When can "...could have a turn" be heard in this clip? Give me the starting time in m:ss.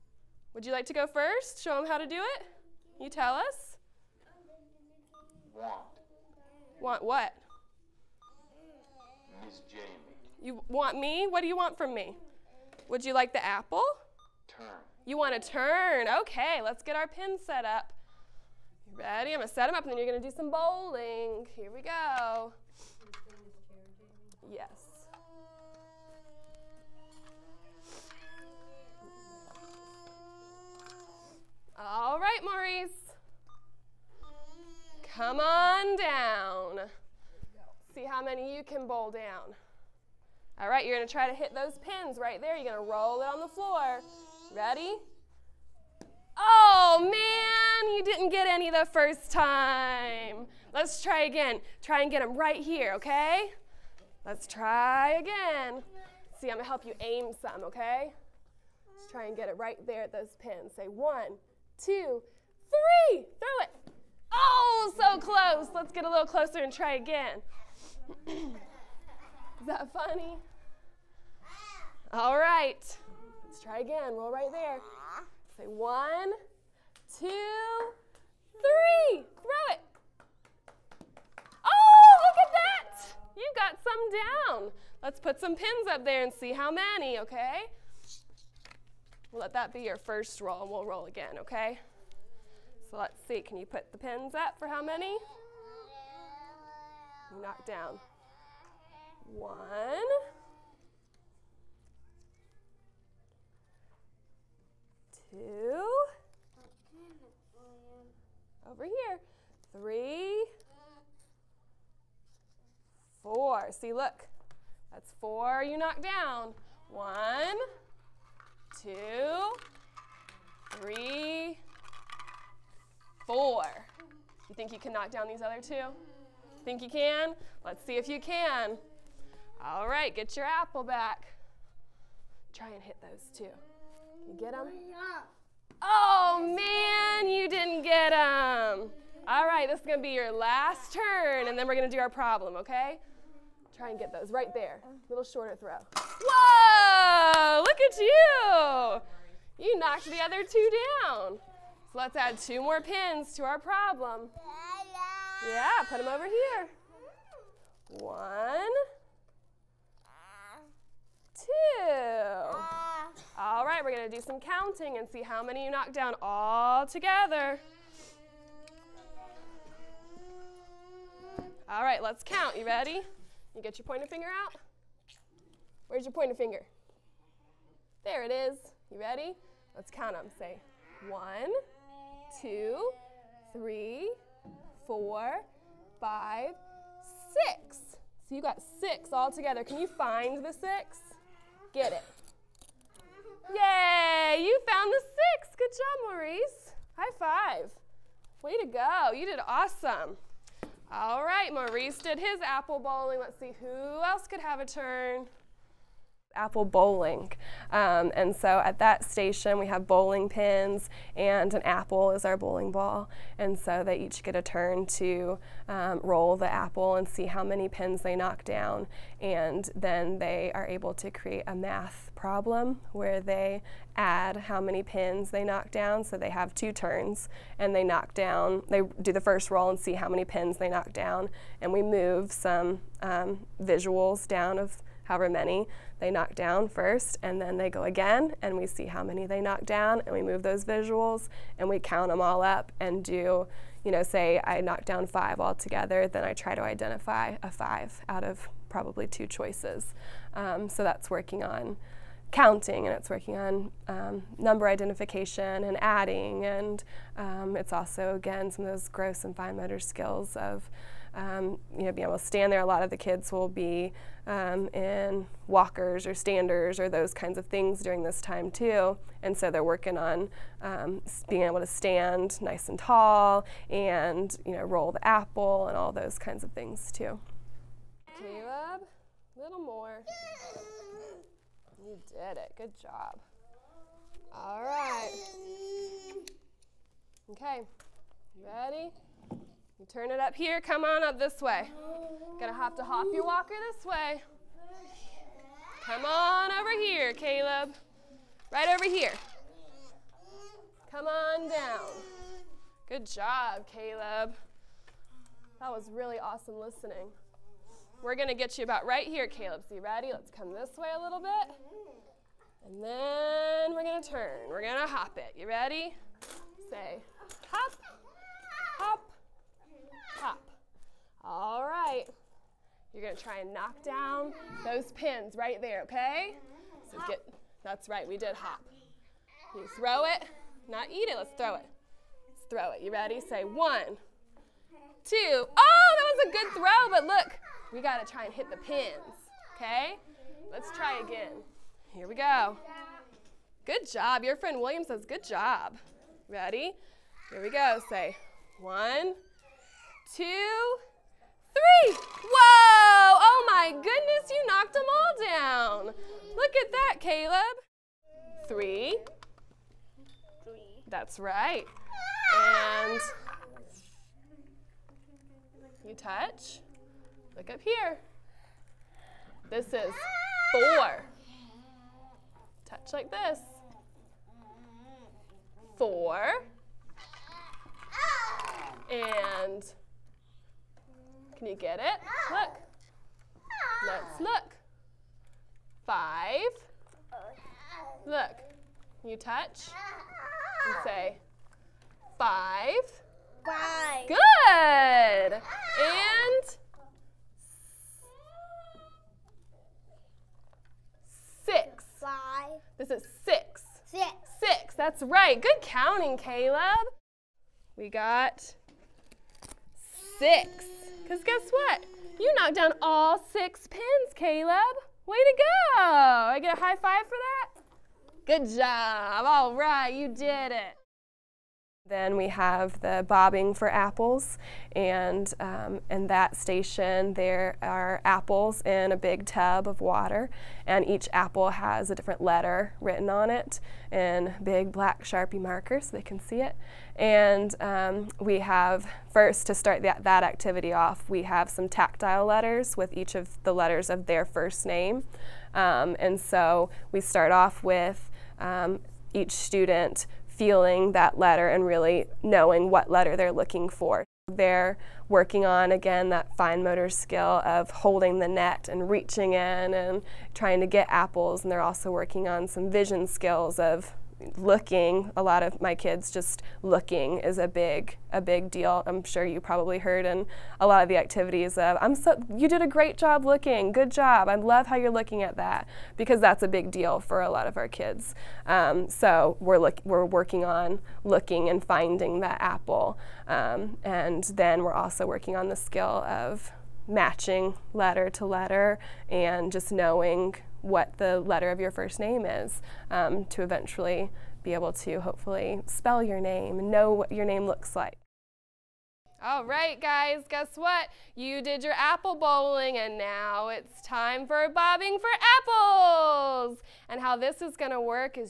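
3:24.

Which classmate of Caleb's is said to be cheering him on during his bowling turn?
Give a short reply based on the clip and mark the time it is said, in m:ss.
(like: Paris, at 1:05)
William, at 5:44.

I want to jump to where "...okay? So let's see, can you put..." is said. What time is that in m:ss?
1:31.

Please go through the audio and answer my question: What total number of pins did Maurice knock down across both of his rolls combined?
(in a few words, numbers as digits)
6.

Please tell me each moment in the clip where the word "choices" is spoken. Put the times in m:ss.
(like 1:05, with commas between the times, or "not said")
4:09.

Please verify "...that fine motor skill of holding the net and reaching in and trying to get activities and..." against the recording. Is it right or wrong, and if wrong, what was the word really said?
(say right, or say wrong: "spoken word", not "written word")
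wrong: "apples", not "activities".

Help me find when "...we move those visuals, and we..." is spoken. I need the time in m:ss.
4:00.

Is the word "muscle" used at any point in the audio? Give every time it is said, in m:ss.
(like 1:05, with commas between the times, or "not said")
not said.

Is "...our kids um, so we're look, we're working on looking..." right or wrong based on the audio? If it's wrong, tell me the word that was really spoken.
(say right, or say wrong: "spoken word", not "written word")
right.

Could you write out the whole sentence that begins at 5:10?
Let's come this way a little bit.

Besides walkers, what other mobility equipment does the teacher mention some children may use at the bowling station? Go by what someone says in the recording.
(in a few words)
standers.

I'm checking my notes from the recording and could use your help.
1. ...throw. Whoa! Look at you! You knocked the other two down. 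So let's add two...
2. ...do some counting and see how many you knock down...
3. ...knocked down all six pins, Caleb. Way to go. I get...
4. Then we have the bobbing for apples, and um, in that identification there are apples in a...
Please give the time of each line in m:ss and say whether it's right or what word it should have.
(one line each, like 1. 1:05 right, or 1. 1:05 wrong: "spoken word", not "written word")
1. 2:25 right
2. 2:44 right
3. 6:52 right
4. 7:01 wrong: "station", not "identification".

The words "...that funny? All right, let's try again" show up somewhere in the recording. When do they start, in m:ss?
1:09.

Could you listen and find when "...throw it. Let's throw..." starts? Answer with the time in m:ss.
5:31.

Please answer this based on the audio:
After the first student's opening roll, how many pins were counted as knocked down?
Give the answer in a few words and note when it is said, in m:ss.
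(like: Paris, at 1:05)
4, at 1:54.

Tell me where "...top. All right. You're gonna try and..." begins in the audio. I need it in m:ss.
5:20.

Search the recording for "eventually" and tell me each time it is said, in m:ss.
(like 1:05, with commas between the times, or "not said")
8:13.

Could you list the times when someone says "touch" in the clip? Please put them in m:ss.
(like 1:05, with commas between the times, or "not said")
6:05, 6:12, 6:29.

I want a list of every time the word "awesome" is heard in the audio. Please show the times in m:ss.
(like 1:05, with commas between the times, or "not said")
3:19, 5:06.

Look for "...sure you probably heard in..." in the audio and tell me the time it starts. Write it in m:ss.
7:49.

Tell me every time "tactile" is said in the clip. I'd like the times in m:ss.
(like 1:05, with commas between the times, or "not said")
7:21.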